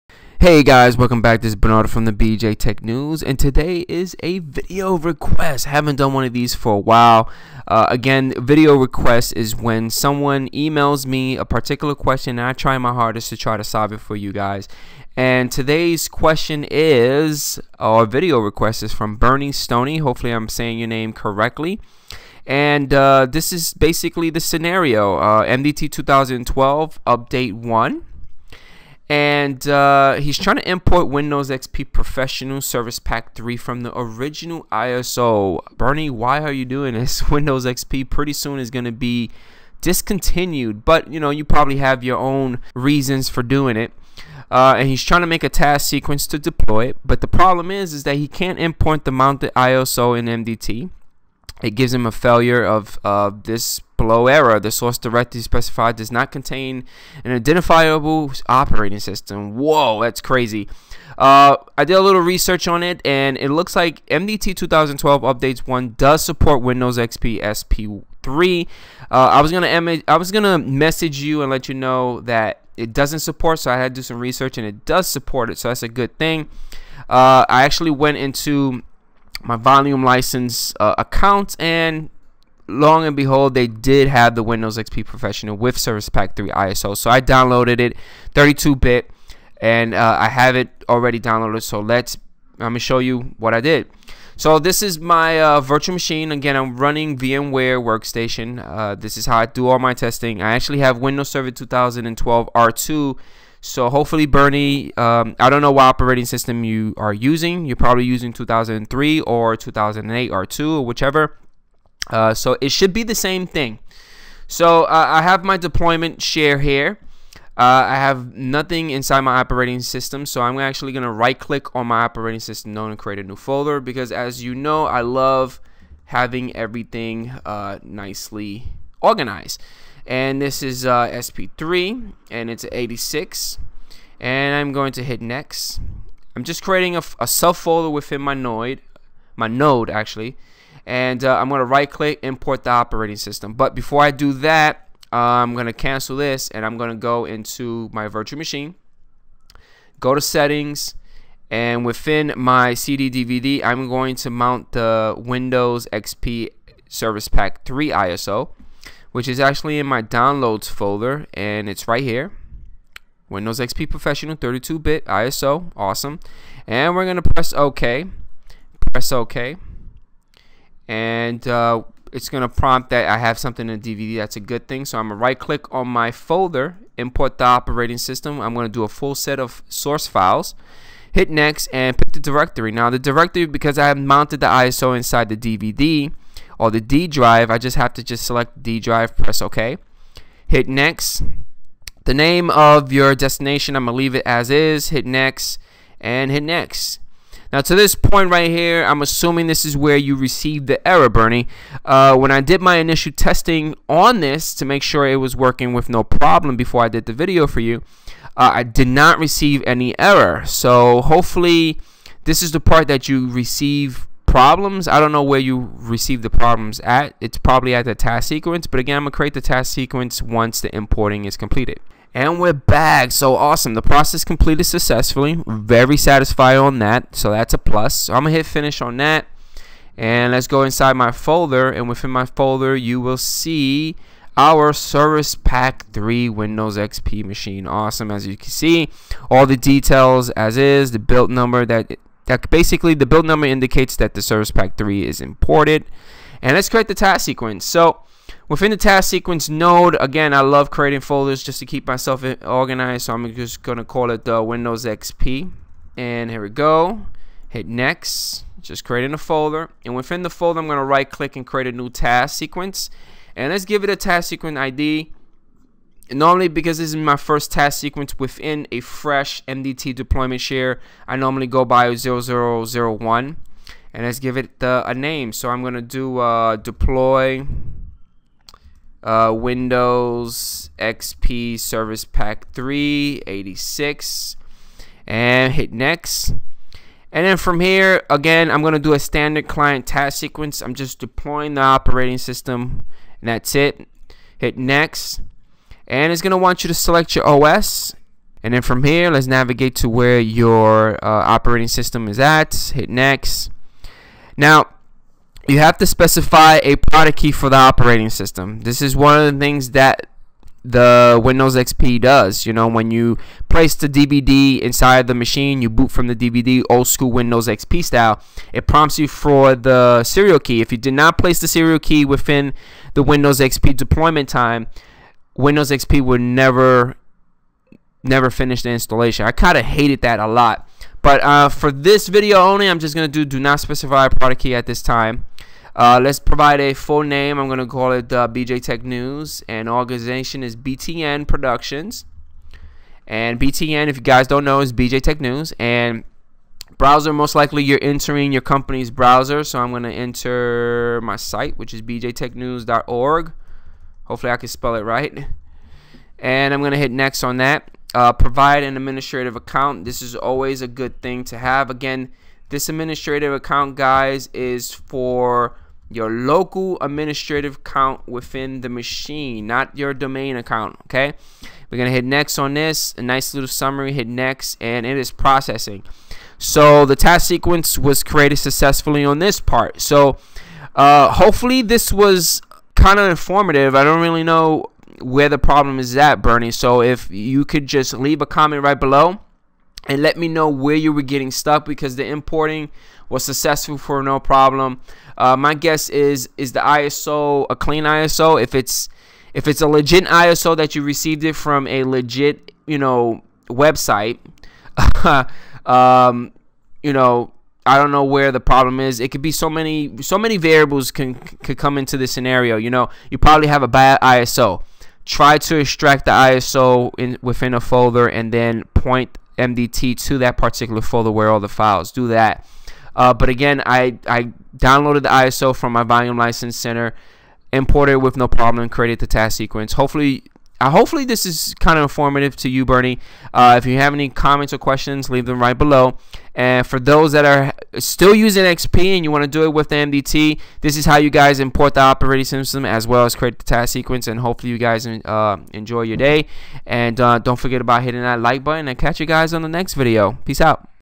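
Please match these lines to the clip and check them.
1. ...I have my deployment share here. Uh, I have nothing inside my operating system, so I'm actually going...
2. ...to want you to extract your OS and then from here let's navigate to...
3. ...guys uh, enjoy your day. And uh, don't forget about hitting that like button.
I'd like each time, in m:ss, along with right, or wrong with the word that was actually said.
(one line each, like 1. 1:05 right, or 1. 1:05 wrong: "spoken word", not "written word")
1. 1:55 right
2. 4:56 wrong: "select", not "extract"
3. 7:24 right.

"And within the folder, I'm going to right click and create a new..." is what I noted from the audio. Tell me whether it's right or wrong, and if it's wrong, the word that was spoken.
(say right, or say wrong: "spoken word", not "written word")
right.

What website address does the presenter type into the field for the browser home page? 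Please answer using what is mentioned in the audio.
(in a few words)
bjtechnews.org.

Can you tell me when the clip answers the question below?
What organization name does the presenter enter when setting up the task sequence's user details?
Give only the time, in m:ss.
5:40.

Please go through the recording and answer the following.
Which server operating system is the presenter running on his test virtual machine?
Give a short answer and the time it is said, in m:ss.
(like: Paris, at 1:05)
Windows Server 2012 R2, at 1:40.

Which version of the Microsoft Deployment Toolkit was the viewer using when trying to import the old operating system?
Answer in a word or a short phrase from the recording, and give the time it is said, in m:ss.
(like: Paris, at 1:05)
MDT 2012 Update 1, at 0:25.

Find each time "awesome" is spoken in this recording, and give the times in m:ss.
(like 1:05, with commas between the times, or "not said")
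2:45, 3:43, 3:57.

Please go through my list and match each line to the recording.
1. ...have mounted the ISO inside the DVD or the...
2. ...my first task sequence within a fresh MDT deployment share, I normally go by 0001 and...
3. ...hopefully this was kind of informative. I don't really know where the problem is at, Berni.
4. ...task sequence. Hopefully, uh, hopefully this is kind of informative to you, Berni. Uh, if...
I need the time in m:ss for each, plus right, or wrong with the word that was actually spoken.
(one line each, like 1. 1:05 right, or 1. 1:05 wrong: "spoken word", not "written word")
1. 3:03 right
2. 4:26 right
3. 6:21 right
4. 7:09 right.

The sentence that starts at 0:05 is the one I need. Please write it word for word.
Haven't done one of these for a while.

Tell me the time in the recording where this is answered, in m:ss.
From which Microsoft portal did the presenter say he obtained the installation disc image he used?
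7:05.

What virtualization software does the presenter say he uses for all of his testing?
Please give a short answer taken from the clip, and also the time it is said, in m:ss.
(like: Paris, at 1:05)
VMware Workstation, at 1:37.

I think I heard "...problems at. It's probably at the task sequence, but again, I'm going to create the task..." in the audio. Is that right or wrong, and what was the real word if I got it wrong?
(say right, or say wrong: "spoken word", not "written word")
right.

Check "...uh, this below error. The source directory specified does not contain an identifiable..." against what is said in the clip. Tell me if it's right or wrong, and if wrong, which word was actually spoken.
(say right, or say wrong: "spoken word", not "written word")
right.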